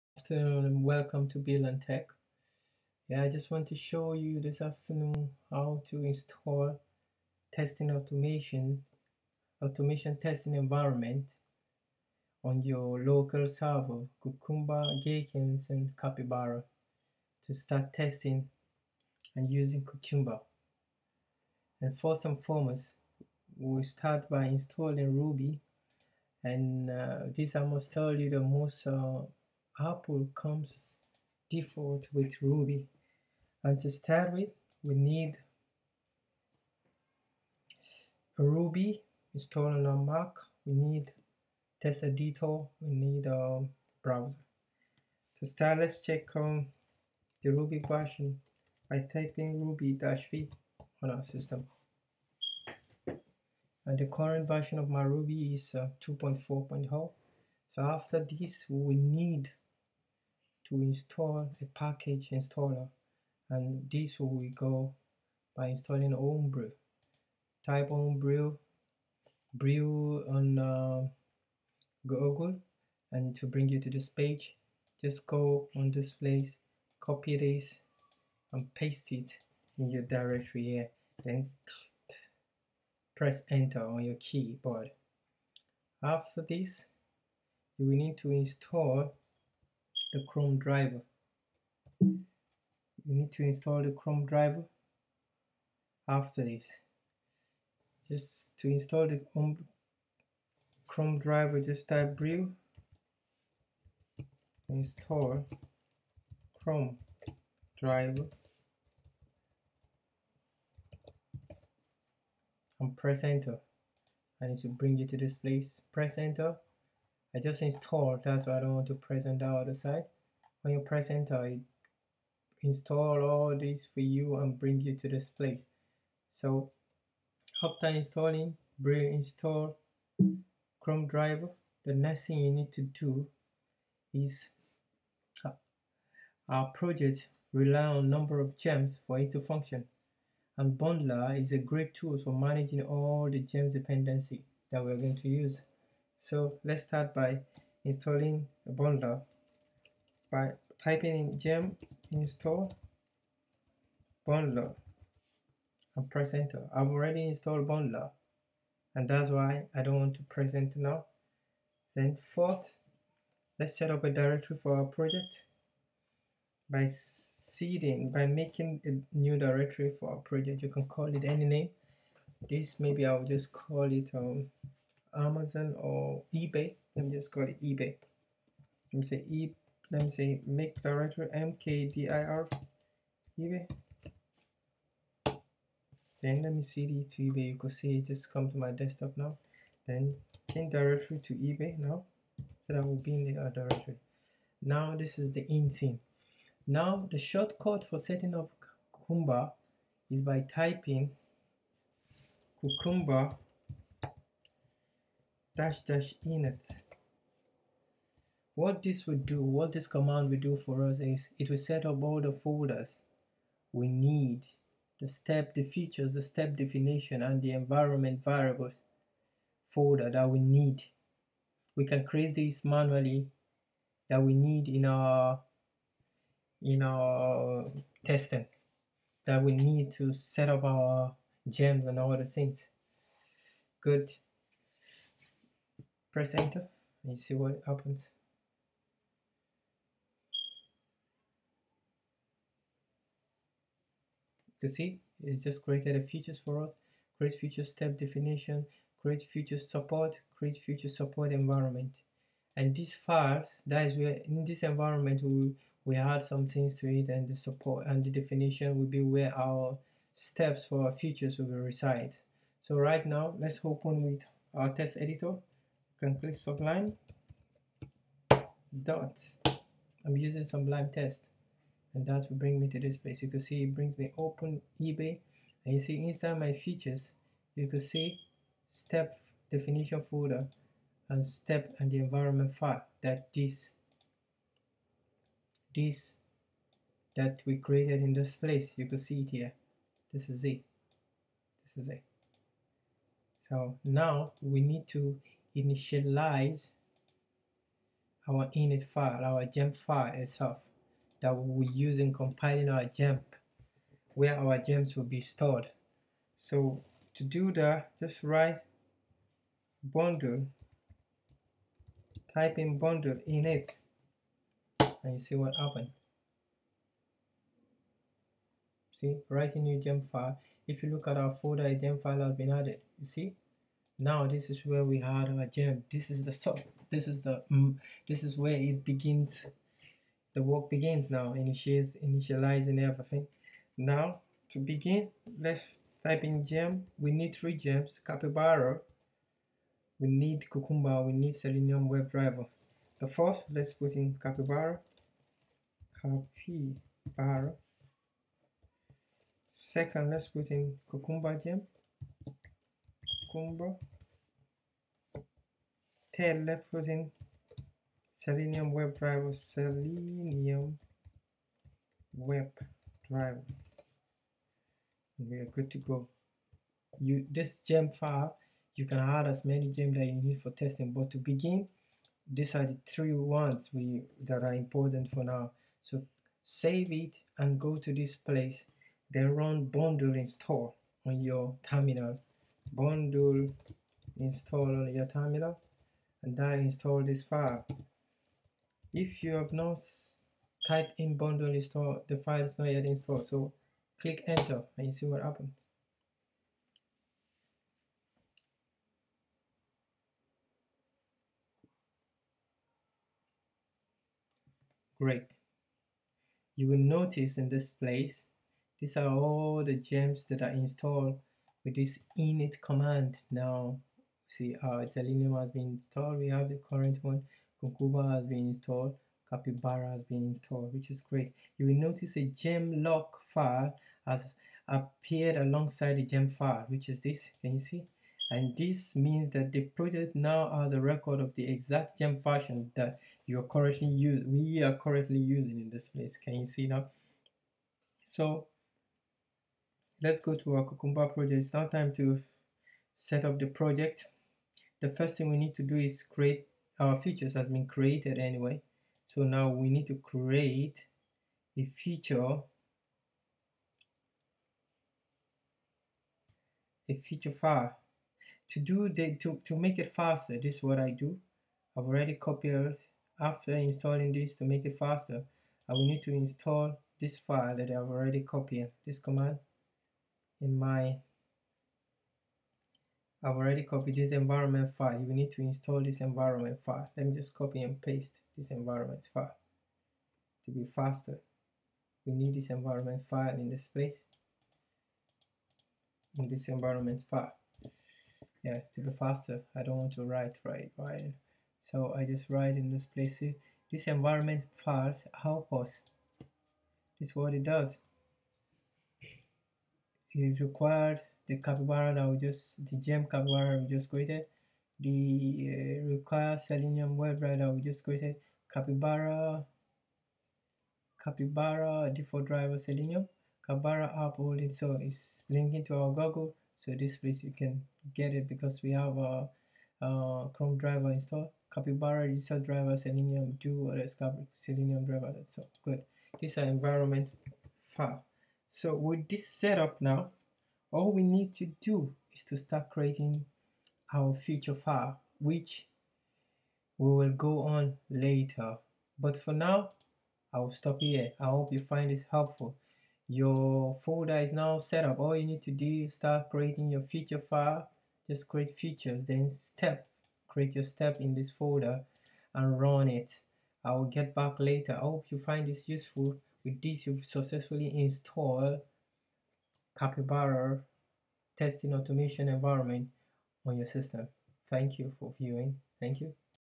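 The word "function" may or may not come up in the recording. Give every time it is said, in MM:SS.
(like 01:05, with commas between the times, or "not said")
02:19.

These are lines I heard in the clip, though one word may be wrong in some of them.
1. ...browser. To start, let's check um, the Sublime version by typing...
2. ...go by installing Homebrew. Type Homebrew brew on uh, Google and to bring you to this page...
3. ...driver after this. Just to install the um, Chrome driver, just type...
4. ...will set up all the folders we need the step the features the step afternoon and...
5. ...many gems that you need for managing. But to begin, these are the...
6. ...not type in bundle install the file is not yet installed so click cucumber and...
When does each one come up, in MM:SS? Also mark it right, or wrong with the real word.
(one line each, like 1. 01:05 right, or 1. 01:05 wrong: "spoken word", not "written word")
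1. 00:44 wrong: "Ruby", not "Sublime"
2. 01:04 right
3. 01:34 right
4. 03:31 wrong: "definition", not "afternoon"
5. 06:09 wrong: "testing", not "managing"
6. 06:29 wrong: "enter", not "cucumber".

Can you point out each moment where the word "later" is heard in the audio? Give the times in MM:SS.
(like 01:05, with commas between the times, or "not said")
08:57, 09:14.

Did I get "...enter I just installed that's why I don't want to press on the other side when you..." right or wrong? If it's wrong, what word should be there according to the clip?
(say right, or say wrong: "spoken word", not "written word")
right.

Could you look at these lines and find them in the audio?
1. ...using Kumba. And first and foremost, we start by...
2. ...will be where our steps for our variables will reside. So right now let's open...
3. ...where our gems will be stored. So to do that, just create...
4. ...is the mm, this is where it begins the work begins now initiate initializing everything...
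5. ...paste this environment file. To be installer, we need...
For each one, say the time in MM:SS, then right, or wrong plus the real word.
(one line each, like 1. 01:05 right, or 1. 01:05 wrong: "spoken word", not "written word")
1. 00:19 wrong: "Cucumber", not "Kumba"
2. 04:18 wrong: "features", not "variables"
3. 05:04 wrong: "write", not "create"
4. 05:27 right
5. 07:57 wrong: "faster", not "installer".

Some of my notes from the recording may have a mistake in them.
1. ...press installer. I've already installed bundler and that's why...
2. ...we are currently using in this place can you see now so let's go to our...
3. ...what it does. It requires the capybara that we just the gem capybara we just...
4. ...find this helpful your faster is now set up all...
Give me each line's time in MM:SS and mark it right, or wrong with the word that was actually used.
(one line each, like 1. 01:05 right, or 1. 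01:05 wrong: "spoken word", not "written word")
1. 02:36 wrong: "enter", not "installer"
2. 07:14 right
3. 08:17 right
4. 09:01 wrong: "folder", not "faster".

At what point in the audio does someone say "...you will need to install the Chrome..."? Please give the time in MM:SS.
01:27.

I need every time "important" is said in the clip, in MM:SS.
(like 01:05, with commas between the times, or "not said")
06:14.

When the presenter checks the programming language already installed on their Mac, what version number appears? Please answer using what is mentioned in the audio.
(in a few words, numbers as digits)
2.4.0.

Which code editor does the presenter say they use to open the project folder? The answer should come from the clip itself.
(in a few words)
Sublime Text.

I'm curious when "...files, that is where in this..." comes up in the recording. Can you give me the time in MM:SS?
04:12.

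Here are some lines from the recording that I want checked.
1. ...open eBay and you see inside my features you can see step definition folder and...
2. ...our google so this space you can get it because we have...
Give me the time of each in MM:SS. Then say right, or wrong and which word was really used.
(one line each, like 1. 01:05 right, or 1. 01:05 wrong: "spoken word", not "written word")
1. 04:34 right
2. 08:35 wrong: "place", not "space".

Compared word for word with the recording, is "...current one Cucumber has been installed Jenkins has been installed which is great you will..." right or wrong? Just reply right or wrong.
wrong.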